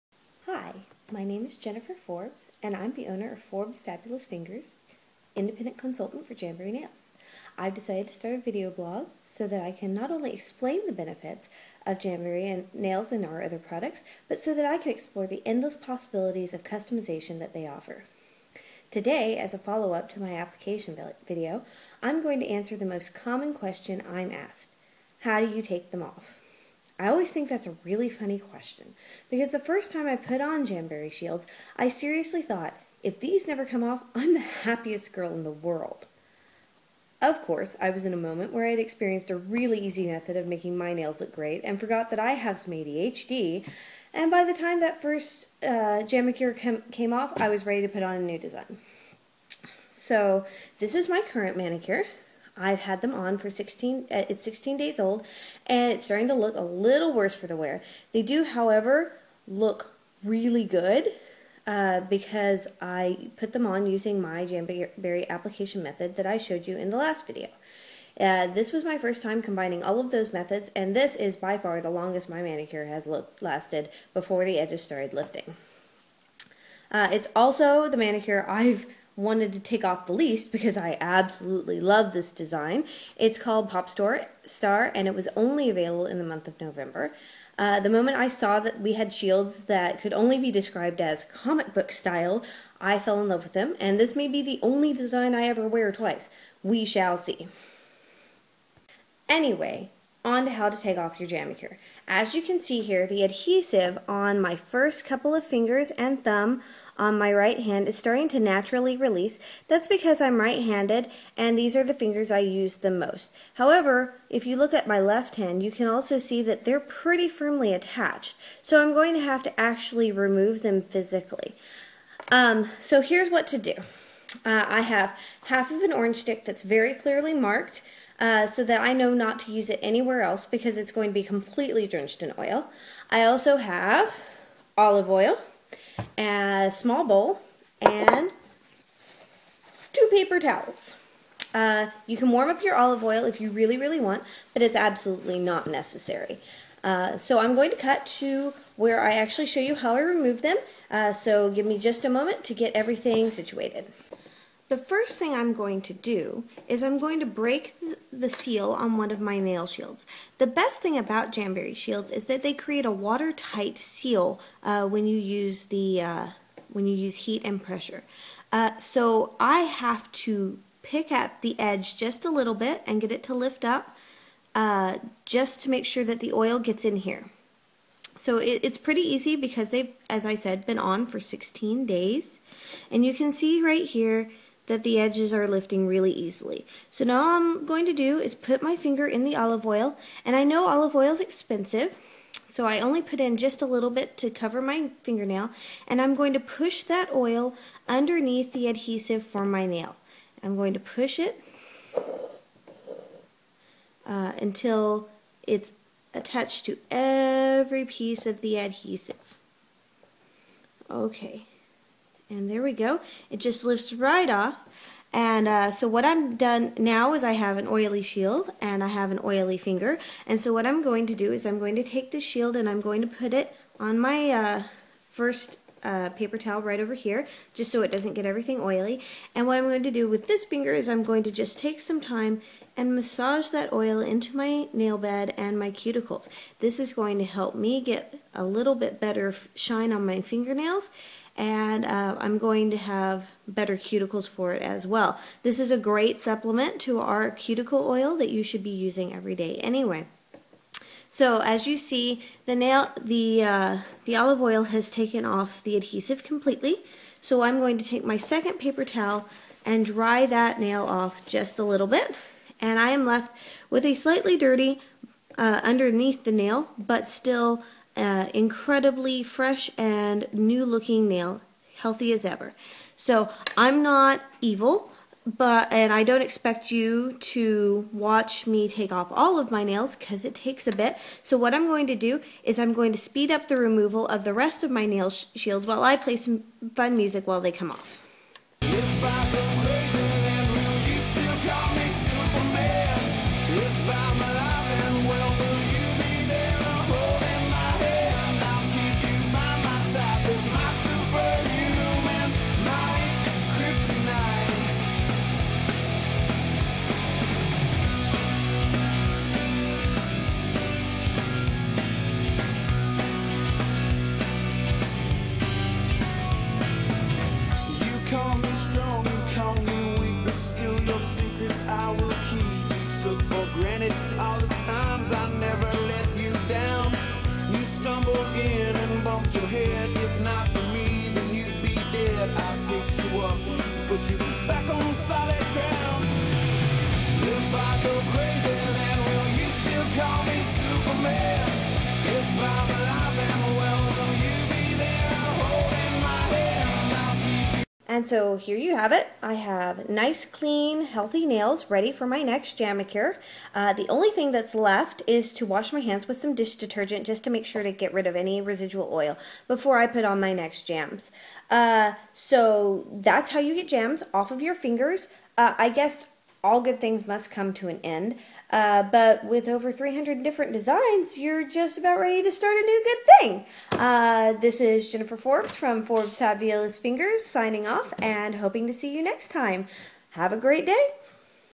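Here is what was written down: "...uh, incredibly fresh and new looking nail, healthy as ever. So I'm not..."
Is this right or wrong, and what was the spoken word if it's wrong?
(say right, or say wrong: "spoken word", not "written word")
right.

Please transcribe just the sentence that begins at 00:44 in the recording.
And by the time that first uh, Cure came off, I was ready to put on a new design.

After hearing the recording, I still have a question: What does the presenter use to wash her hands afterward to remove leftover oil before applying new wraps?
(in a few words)
dish detergent.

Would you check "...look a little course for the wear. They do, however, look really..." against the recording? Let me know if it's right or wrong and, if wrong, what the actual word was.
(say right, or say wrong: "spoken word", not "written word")
wrong: "worse", not "course".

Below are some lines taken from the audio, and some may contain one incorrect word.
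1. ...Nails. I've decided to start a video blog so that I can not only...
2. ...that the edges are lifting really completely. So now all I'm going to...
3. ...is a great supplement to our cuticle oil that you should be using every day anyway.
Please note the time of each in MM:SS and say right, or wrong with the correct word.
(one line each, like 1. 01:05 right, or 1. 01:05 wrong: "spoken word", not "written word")
1. 00:06 right
2. 03:04 wrong: "easily", not "completely"
3. 04:05 right.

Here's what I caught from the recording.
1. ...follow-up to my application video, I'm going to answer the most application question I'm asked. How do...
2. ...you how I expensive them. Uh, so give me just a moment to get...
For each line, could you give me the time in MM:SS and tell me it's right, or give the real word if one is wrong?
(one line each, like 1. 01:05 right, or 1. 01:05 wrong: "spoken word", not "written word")
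1. 00:19 wrong: "common", not "application"
2. 02:29 wrong: "remove", not "expensive".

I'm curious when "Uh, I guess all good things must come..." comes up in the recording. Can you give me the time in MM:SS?
06:05.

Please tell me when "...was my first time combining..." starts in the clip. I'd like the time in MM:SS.
01:08.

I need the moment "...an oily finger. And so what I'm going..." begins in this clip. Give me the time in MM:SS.
03:39.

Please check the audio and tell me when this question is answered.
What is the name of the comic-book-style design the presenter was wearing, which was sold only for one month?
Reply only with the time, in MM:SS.
01:23.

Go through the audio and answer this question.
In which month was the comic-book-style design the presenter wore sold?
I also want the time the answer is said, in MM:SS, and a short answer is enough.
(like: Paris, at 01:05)
November, at 01:26.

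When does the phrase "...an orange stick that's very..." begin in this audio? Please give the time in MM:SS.
02:05.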